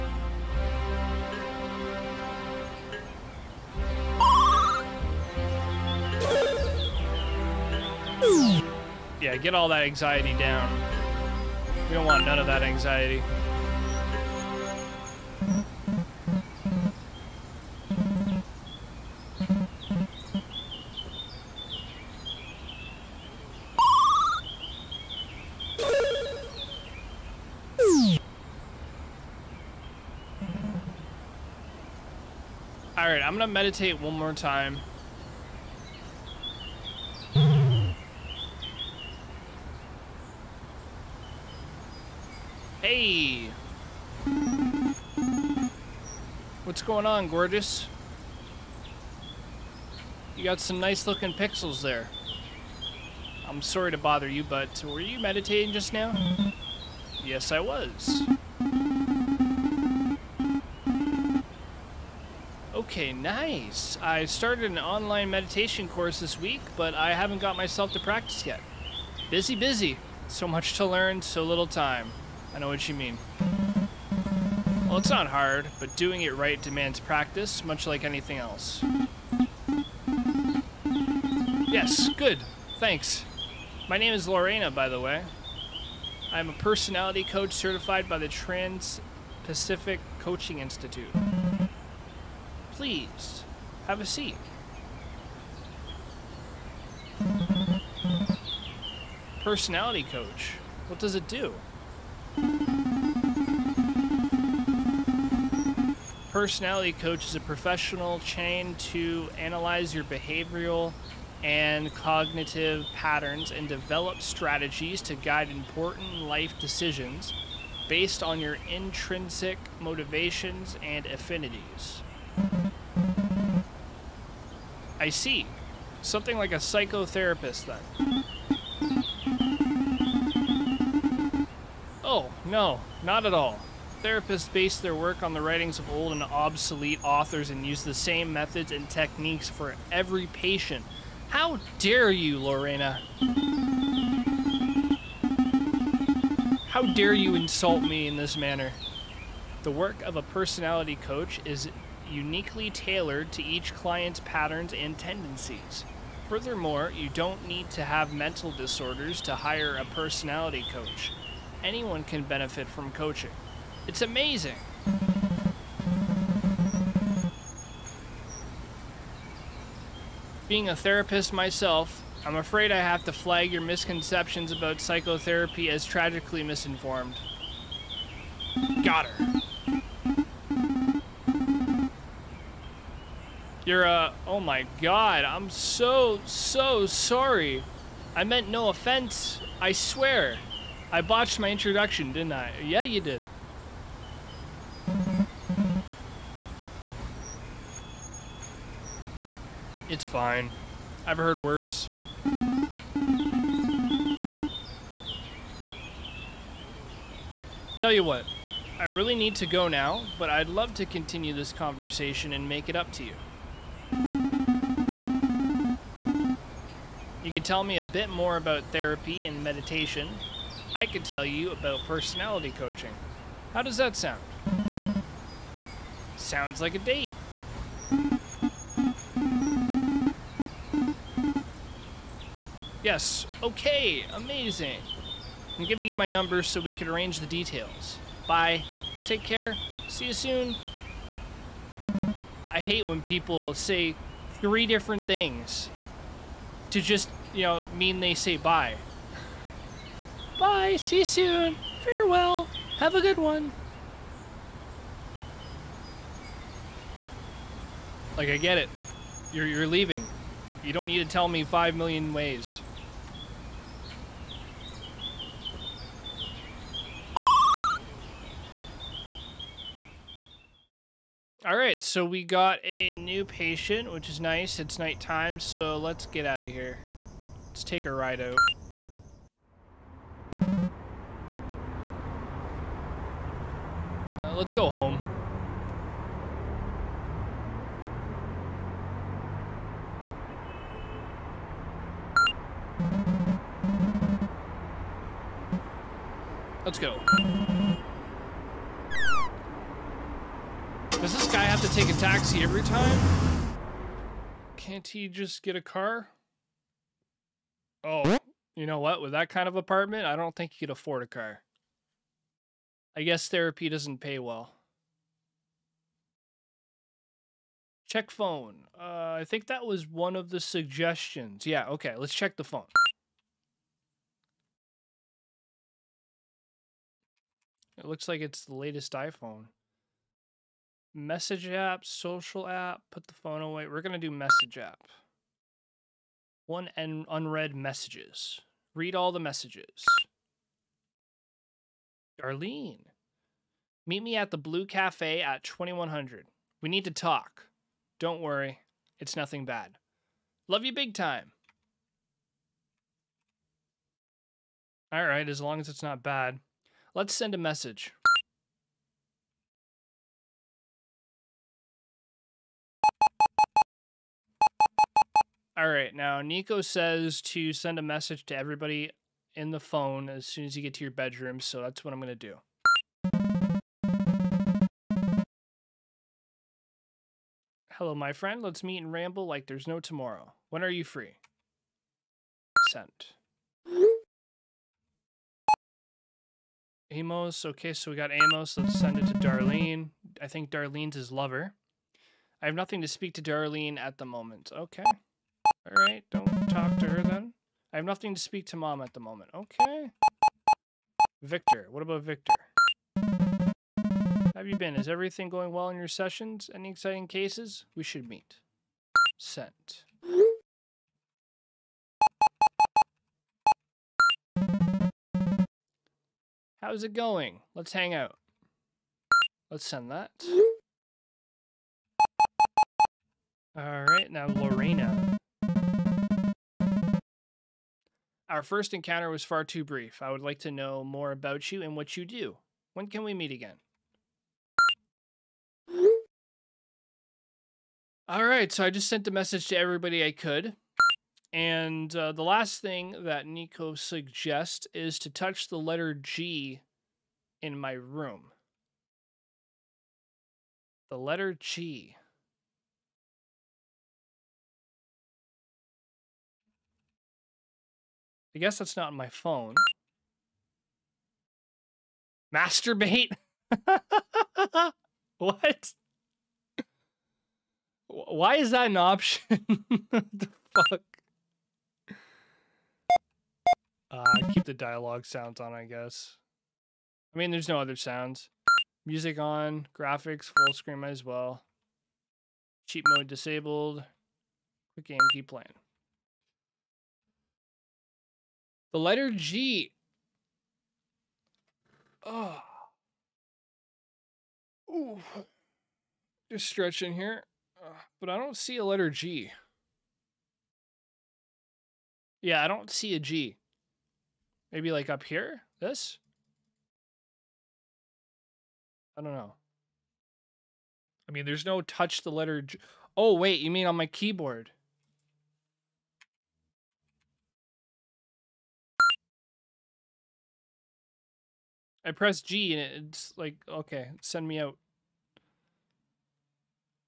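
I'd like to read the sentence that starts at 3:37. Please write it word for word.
You could tell me a bit more about therapy and meditation.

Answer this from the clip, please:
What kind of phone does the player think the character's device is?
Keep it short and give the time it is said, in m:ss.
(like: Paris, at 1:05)
latest iPhone, at 5:28.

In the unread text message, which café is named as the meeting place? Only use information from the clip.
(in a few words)
Blue Cafe.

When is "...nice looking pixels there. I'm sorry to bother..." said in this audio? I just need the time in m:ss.
0:50.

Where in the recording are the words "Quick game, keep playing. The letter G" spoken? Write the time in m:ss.
8:04.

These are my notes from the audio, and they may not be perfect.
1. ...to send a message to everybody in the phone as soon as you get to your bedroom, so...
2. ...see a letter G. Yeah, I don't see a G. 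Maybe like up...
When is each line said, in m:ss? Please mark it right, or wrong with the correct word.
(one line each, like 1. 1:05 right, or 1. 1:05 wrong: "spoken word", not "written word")
1. 6:07 right
2. 8:18 right.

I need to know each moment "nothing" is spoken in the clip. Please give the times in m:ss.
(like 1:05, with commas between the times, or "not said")
5:49, 6:32, 6:37.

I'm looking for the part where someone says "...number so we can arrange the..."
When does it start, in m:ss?
3:56.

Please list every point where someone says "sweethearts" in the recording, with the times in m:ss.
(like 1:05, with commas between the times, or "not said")
not said.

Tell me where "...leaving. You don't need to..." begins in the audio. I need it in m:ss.
4:19.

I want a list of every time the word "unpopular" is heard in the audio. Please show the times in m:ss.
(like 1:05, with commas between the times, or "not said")
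not said.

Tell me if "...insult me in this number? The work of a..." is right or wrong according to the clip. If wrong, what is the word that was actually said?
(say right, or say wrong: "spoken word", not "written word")
wrong: "manner", not "number".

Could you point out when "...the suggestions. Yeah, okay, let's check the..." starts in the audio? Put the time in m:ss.
5:20.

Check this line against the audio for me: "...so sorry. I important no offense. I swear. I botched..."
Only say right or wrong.
wrong.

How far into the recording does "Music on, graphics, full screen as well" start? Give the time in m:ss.
7:58.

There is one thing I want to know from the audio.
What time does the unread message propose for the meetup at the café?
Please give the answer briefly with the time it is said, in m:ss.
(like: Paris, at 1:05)
2100, at 5:45.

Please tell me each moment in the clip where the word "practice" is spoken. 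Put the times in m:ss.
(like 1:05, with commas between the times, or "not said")
1:07, 1:16.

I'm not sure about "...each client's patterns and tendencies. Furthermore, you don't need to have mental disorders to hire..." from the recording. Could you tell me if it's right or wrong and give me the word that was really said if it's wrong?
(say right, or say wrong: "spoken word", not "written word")
right.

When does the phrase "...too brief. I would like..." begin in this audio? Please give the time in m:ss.
7:09.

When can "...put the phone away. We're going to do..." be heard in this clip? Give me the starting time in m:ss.
5:32.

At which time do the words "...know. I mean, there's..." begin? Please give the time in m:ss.
8:29.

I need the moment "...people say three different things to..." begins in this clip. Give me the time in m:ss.
4:03.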